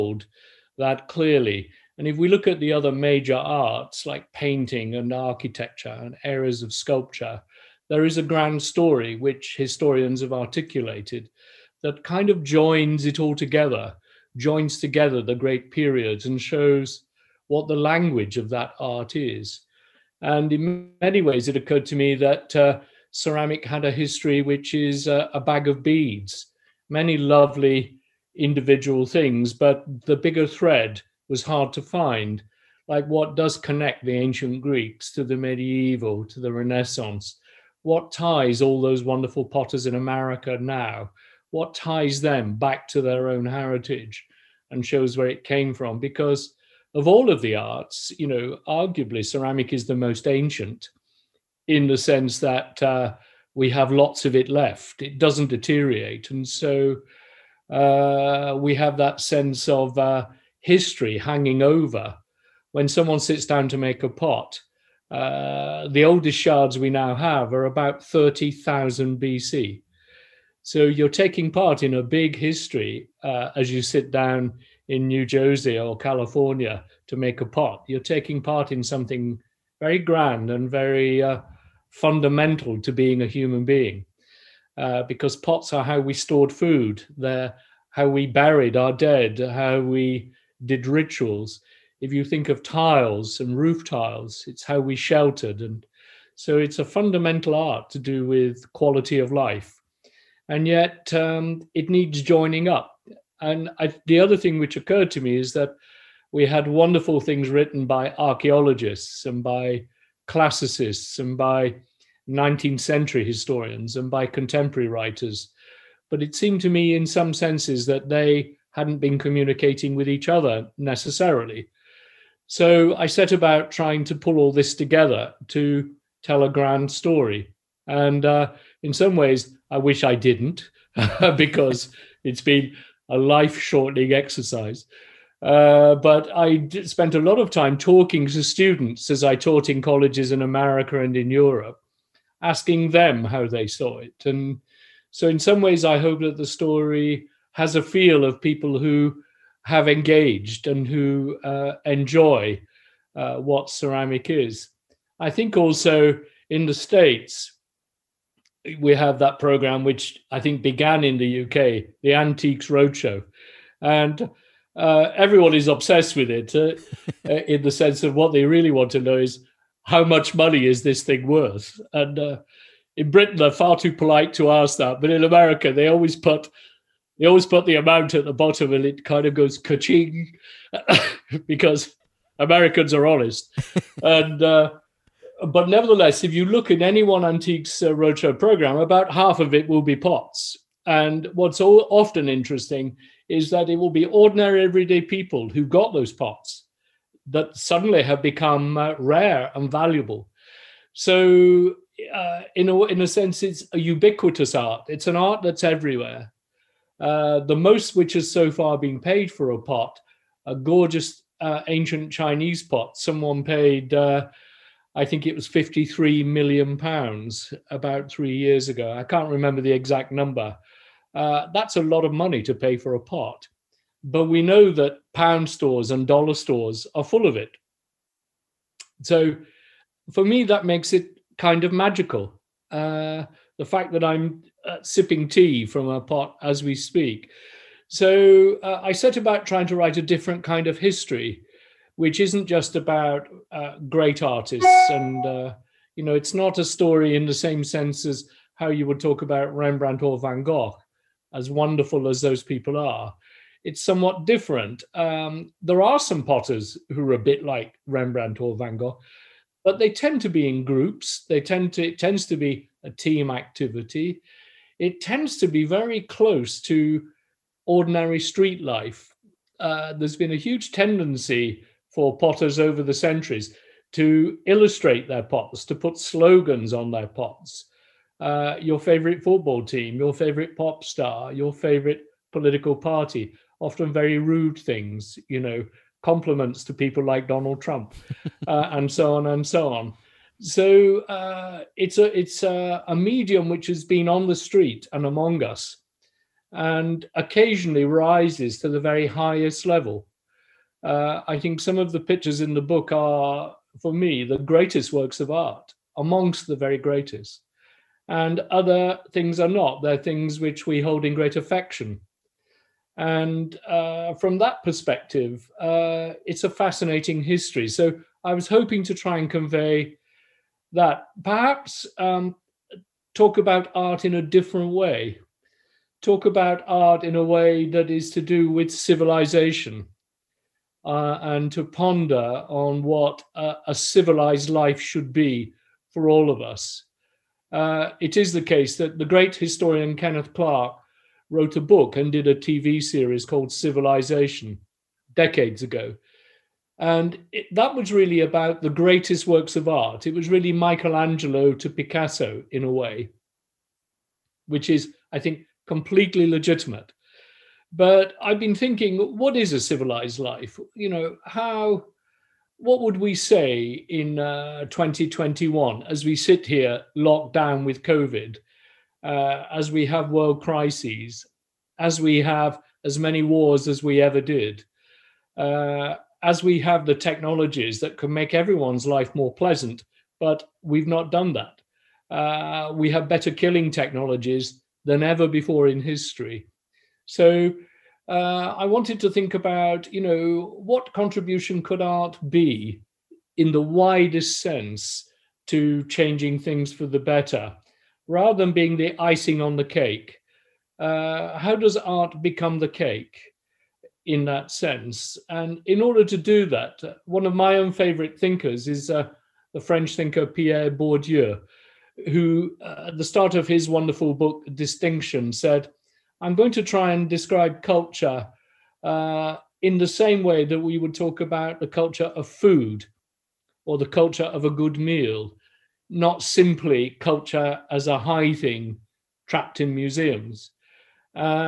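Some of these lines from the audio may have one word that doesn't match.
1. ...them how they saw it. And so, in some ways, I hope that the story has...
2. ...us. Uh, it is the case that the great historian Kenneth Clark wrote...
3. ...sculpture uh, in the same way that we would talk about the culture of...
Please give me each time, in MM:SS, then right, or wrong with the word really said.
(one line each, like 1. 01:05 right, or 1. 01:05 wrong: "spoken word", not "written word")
1. 02:22 right
2. 05:36 right
3. 06:57 wrong: "culture", not "sculpture".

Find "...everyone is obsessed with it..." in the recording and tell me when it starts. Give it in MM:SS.
02:45.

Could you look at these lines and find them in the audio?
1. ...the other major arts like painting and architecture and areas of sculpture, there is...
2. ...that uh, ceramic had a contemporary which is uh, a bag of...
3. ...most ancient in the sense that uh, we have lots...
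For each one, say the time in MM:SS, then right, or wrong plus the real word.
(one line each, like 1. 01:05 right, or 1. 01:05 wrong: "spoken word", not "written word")
1. 00:02 right
2. 00:22 wrong: "history", not "contemporary"
3. 00:49 right.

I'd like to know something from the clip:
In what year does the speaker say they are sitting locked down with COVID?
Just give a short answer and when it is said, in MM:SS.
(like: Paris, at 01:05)
2021, at 06:04.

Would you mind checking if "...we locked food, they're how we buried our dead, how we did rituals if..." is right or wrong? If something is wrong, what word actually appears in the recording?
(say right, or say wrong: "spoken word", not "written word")
wrong: "stored", not "locked".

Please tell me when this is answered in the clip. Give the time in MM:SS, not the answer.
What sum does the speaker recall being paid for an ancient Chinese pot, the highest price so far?
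03:35.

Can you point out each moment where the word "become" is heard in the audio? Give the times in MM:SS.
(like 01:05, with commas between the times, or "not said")
03:18, 06:42.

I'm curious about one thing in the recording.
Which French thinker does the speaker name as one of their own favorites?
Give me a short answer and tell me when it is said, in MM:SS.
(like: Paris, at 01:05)
Pierre Bourdieu, at 06:50.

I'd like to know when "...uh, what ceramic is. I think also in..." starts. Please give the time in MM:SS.
02:33.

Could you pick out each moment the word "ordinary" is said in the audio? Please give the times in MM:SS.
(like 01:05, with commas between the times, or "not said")
03:14, 04:27.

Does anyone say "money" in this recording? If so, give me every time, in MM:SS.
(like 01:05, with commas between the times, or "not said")
02:50, 03:42.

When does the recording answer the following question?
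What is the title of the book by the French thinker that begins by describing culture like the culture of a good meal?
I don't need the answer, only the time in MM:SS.
06:54.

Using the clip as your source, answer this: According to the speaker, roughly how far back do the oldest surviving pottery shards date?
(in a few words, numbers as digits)
30,000 BC.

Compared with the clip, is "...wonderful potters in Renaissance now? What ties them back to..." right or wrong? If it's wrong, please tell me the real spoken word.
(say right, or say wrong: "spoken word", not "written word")
wrong: "America", not "Renaissance".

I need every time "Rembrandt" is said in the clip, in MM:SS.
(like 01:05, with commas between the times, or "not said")
04:09, 04:17.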